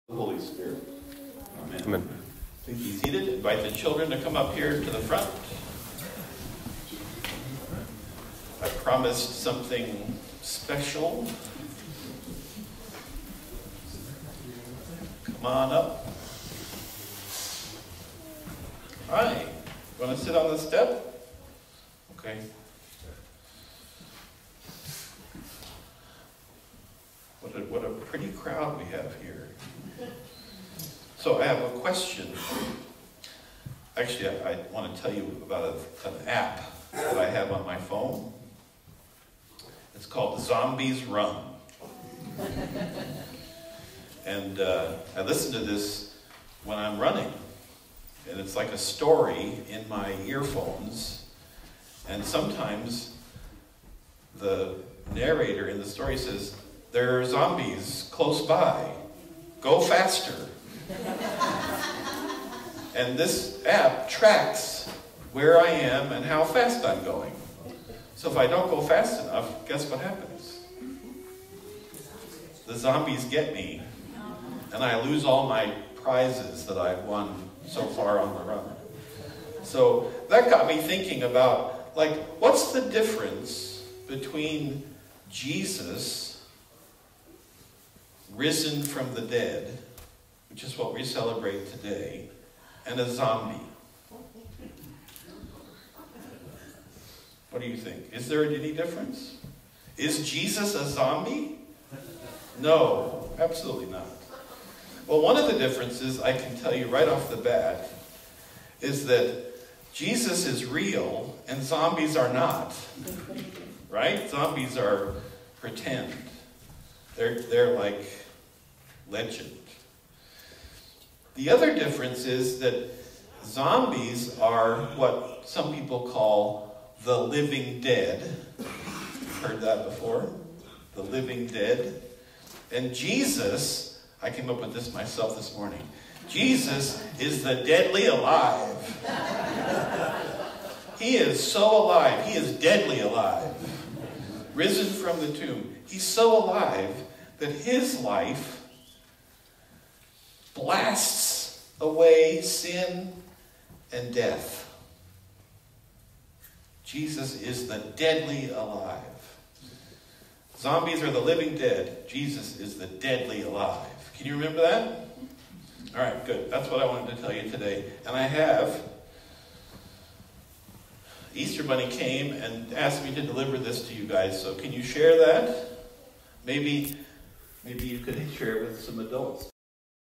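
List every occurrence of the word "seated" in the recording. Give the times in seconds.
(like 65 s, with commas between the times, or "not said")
2 s.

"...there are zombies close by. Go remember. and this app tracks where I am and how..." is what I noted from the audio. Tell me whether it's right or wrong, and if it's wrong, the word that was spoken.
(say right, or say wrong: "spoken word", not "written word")
wrong: "faster", not "remember".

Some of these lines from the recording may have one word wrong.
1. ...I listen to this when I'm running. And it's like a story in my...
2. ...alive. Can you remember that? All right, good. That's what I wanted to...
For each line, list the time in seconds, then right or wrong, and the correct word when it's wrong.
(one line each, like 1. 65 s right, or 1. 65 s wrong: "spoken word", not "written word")
1. 45 s right
2. 163 s right.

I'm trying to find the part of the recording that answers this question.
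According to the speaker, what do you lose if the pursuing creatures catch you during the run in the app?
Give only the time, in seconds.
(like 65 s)
75 s.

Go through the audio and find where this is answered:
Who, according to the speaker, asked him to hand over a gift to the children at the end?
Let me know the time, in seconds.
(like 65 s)
171 s.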